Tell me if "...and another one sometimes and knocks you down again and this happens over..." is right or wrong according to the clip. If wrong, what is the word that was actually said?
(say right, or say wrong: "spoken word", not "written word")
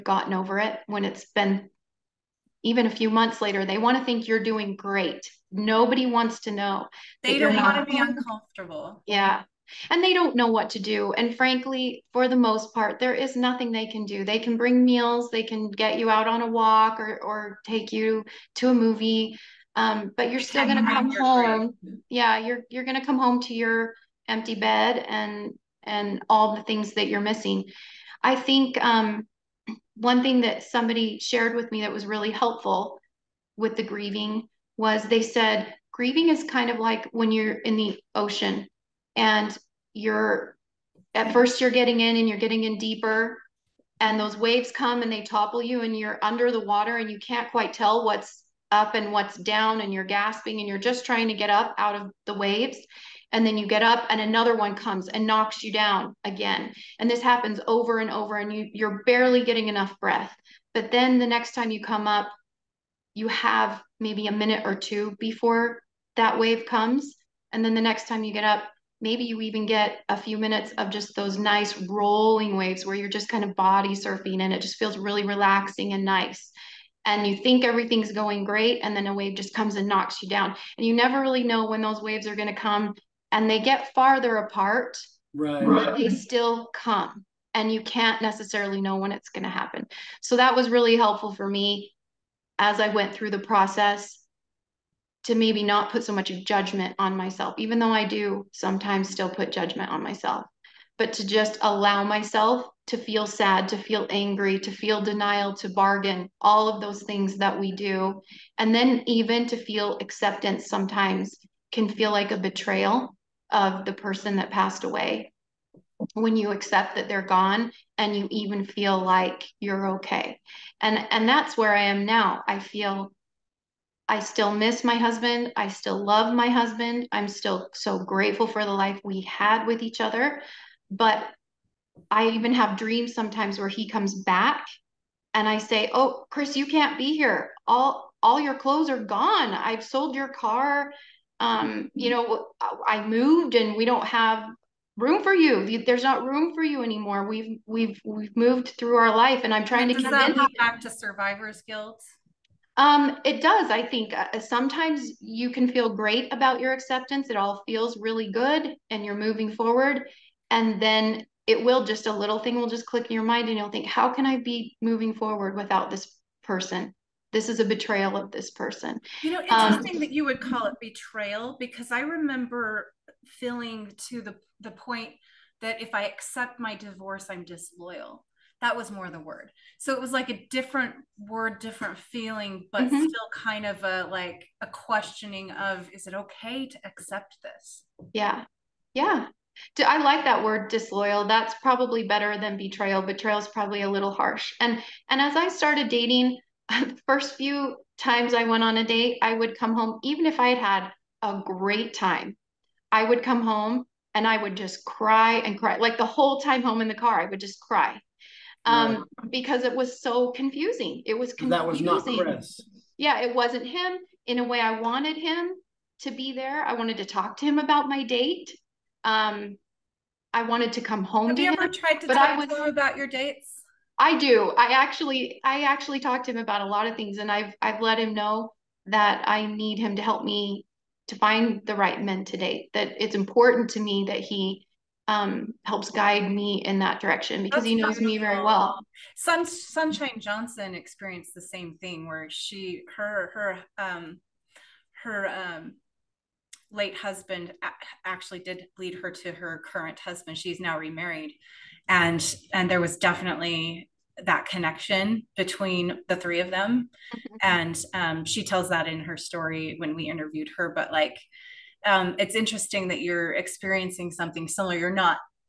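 wrong: "comes", not "sometimes".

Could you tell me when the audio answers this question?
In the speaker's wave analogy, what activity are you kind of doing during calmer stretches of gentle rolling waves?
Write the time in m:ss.
1:13.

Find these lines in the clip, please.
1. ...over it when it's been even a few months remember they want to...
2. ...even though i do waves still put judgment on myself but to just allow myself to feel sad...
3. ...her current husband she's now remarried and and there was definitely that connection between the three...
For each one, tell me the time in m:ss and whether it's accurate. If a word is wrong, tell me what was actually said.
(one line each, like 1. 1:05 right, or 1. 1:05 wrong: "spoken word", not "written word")
1. 0:00 wrong: "later", not "remember"
2. 1:37 wrong: "sometimes", not "waves"
3. 4:09 right.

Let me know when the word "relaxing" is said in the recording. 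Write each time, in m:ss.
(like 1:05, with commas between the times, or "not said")
1:15.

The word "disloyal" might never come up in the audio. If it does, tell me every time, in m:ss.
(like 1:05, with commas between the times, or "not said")
2:57, 3:10.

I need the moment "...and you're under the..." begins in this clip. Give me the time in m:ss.
0:45.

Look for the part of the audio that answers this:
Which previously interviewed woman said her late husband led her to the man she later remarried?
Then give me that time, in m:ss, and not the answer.
3:59.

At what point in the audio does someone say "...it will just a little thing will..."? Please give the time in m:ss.
2:41.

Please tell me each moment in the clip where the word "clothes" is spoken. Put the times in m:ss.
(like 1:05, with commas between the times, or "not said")
2:18.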